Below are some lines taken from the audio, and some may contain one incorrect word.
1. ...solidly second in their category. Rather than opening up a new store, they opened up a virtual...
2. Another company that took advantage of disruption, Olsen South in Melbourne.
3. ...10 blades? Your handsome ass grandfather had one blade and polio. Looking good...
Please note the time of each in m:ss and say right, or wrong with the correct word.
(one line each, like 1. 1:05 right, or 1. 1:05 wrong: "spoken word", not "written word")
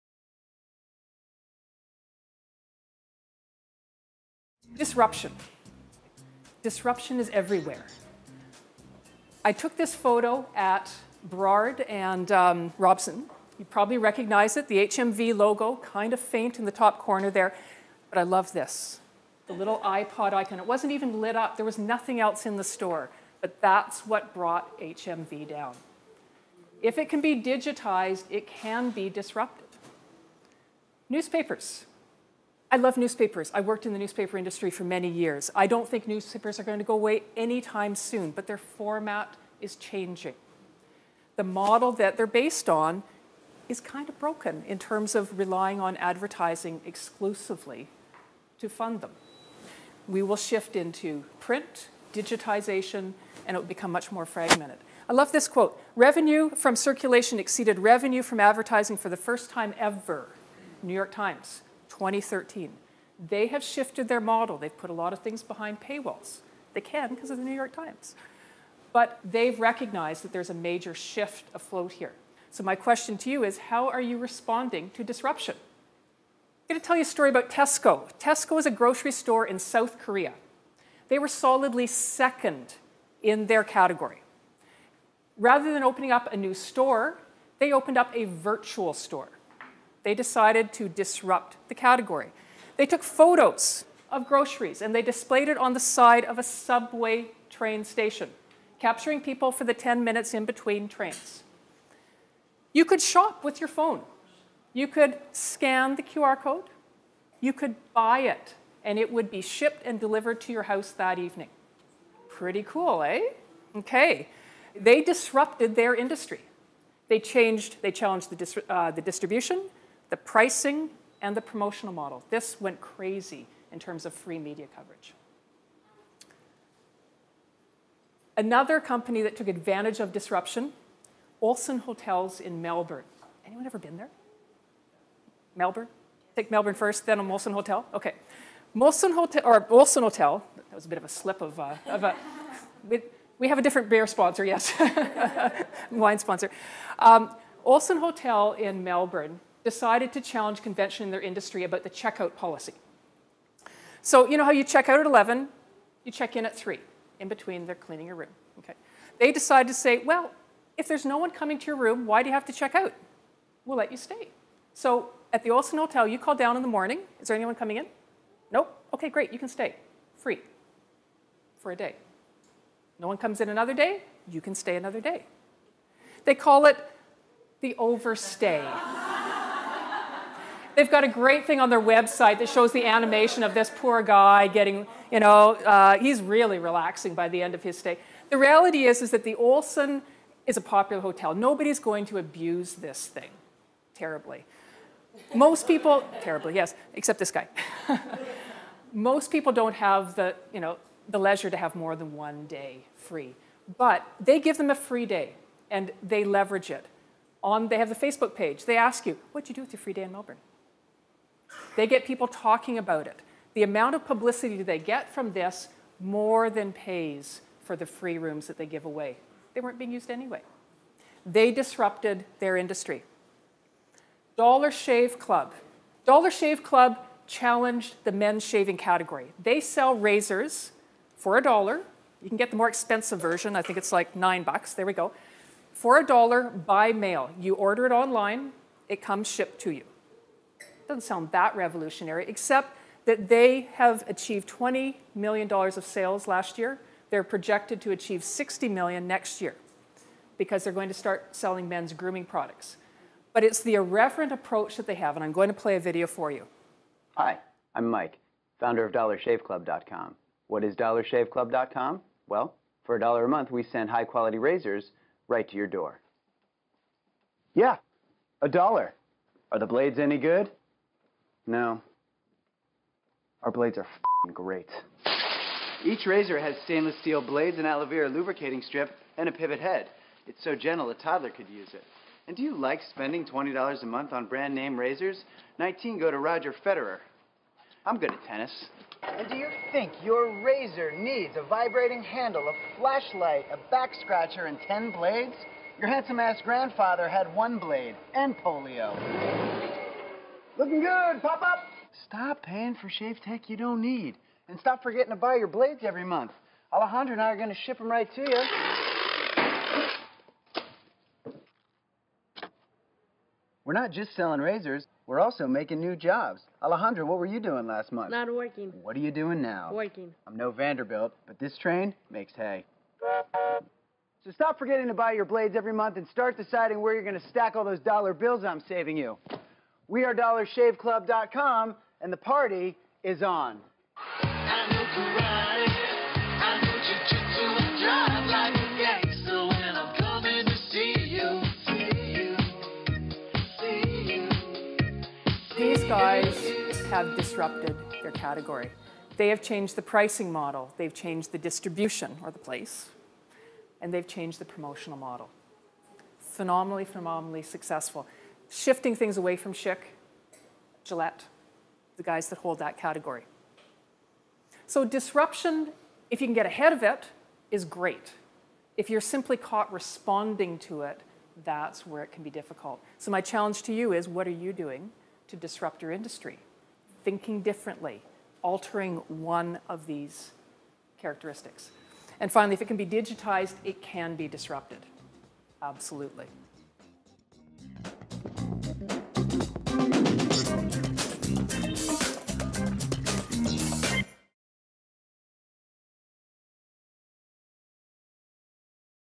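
1. 1:21 right
2. 2:08 wrong: "Hotels", not "South"
3. 4:54 right.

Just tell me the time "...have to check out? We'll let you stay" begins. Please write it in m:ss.
2:42.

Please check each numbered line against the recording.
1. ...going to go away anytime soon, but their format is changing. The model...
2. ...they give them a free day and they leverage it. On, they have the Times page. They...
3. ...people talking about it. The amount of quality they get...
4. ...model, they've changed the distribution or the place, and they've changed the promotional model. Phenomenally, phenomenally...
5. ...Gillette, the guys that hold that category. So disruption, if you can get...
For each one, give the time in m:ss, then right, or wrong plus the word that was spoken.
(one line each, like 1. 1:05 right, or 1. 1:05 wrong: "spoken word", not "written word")
1. 0:36 right
2. 3:24 wrong: "Facebook", not "Times"
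3. 3:32 wrong: "publicity", not "quality"
4. 5:50 right
5. 6:00 right.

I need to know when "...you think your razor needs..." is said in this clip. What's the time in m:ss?
4:49.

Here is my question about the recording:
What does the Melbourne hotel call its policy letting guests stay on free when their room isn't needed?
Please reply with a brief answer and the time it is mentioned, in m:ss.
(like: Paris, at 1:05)
the overstay, at 2:57.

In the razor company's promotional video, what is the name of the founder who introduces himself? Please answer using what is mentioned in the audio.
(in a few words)
Mike.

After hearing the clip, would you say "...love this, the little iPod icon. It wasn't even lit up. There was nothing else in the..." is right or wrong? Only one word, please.
right.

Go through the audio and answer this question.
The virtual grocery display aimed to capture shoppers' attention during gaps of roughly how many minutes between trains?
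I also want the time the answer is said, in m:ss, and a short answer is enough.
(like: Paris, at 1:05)
10 minutes, at 1:39.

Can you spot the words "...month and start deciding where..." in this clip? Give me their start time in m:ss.
5:25.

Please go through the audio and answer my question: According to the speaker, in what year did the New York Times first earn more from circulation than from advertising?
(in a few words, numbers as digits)
2013.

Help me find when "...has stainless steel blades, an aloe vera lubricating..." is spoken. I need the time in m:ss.
4:36.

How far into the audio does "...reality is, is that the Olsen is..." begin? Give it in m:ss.
3:08.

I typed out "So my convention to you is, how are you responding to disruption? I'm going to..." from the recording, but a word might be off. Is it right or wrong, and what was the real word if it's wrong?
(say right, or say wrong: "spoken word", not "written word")
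wrong: "question", not "convention".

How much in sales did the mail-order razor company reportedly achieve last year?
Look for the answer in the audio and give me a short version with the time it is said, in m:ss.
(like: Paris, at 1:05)
$20 million, at 4:04.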